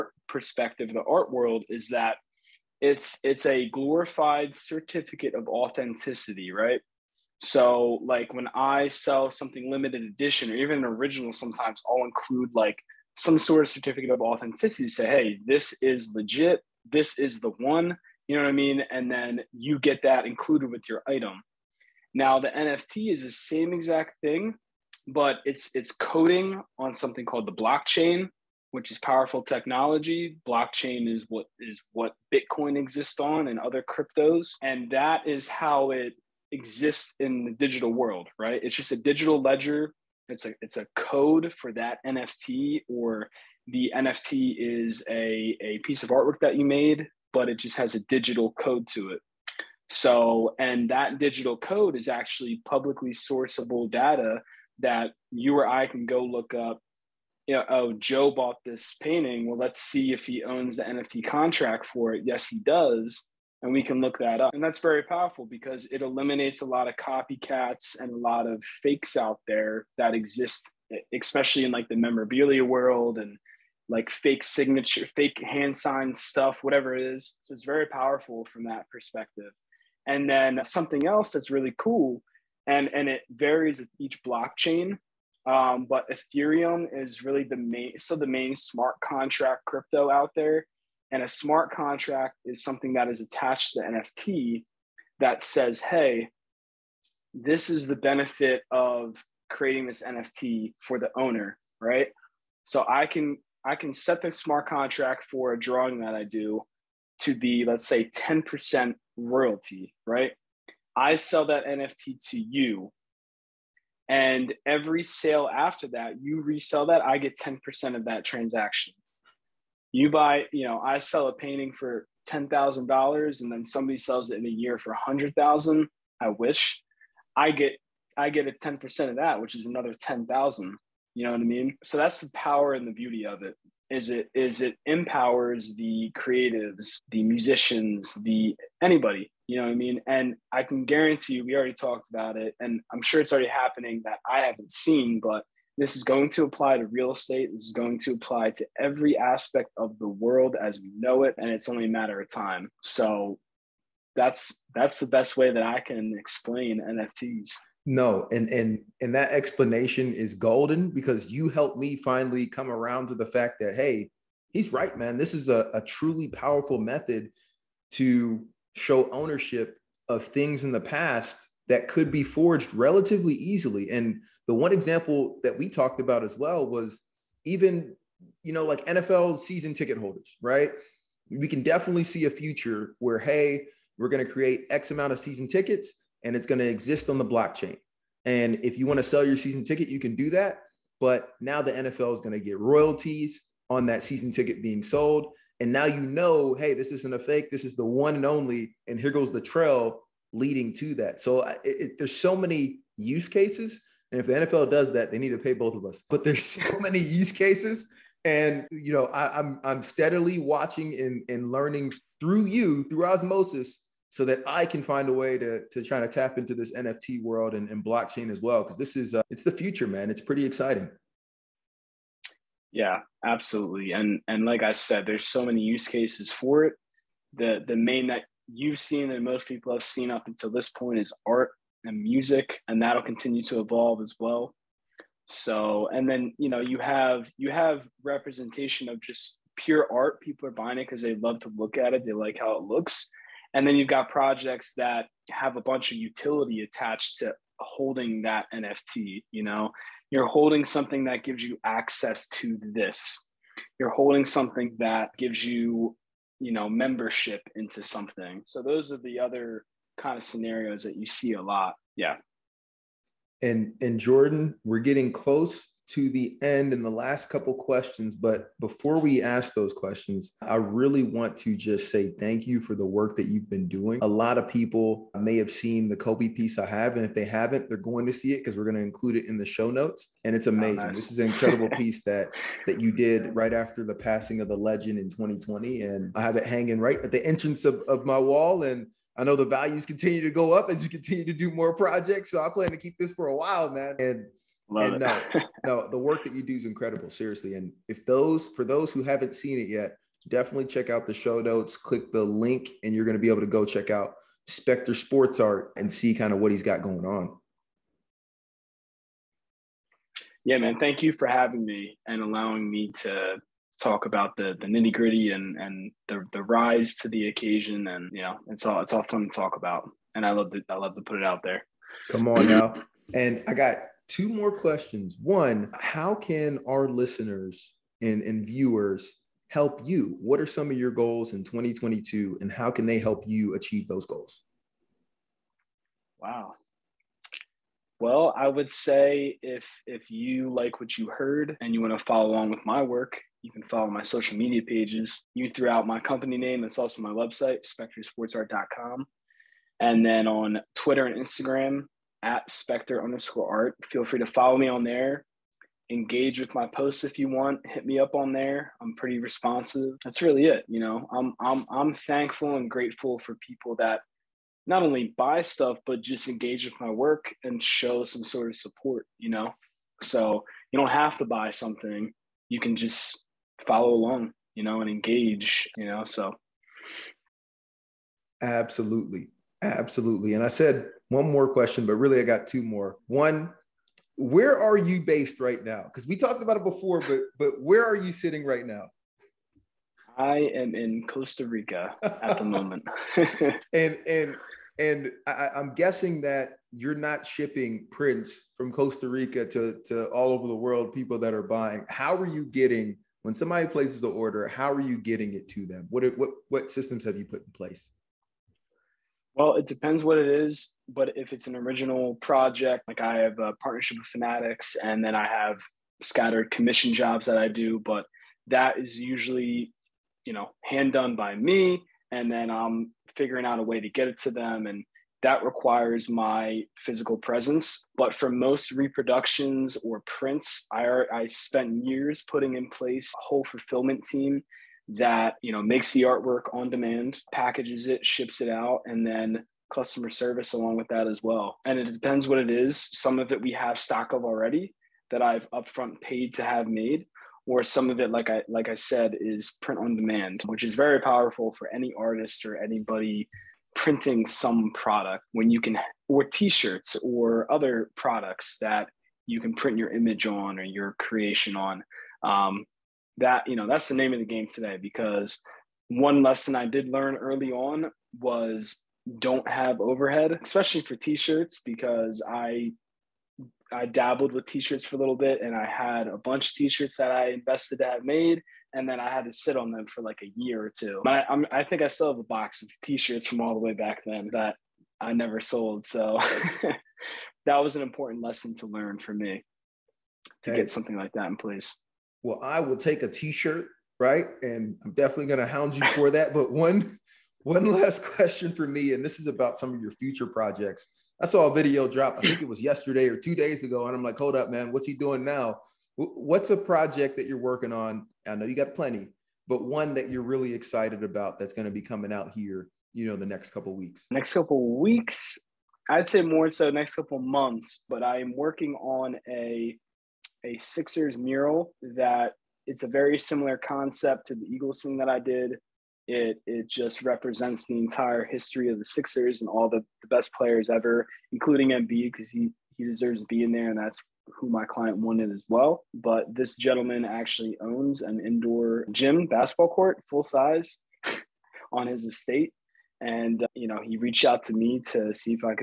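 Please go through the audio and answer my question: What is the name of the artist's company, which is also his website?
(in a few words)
Spector Sports Art.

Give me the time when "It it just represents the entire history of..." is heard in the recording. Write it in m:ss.
8:46.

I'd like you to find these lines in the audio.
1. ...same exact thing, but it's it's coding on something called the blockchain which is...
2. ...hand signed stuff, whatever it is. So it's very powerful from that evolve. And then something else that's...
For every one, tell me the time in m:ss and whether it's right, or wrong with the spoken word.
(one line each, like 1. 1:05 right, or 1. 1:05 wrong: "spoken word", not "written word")
1. 0:23 right
2. 1:15 wrong: "perspective", not "evolve".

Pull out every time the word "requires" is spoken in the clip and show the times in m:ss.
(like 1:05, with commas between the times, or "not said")
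7:05.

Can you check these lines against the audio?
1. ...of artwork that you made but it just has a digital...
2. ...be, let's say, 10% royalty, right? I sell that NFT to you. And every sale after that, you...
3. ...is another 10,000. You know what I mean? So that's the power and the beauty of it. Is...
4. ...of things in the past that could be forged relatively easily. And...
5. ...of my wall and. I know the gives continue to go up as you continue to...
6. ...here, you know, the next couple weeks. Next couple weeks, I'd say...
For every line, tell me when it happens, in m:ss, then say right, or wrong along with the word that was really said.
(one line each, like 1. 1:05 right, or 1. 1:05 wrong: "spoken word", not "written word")
1. 0:46 right
2. 1:47 right
3. 2:09 right
4. 2:50 right
5. 4:47 wrong: "values", not "gives"
6. 8:32 right.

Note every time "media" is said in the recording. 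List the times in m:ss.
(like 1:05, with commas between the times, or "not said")
5:44.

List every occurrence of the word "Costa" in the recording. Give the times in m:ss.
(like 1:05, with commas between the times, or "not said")
6:31, 6:38.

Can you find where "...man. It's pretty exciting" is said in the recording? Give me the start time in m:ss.
3:39.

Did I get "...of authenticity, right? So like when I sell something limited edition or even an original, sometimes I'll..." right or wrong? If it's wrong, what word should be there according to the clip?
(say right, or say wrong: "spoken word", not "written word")
right.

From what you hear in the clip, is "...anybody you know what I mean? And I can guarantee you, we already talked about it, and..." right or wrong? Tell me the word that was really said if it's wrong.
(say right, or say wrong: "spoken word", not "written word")
right.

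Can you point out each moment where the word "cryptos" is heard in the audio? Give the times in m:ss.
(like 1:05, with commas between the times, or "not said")
0:33, 1:29.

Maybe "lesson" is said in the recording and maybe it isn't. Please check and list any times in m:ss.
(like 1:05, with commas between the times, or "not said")
7:46, 8:08.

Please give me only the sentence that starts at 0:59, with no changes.
Well, let's see if he owns the NFT contract for it.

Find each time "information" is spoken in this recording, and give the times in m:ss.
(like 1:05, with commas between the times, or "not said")
not said.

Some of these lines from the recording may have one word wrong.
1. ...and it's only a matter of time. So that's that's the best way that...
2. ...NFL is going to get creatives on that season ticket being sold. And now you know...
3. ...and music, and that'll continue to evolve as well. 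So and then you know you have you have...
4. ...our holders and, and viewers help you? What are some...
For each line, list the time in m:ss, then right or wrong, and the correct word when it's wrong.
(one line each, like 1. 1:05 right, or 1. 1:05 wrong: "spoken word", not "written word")
1. 2:31 right
2. 3:11 wrong: "royalties", not "creatives"
3. 3:51 right
4. 5:26 wrong: "listeners", not "holders".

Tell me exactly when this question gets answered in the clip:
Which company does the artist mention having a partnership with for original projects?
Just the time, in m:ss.
6:54.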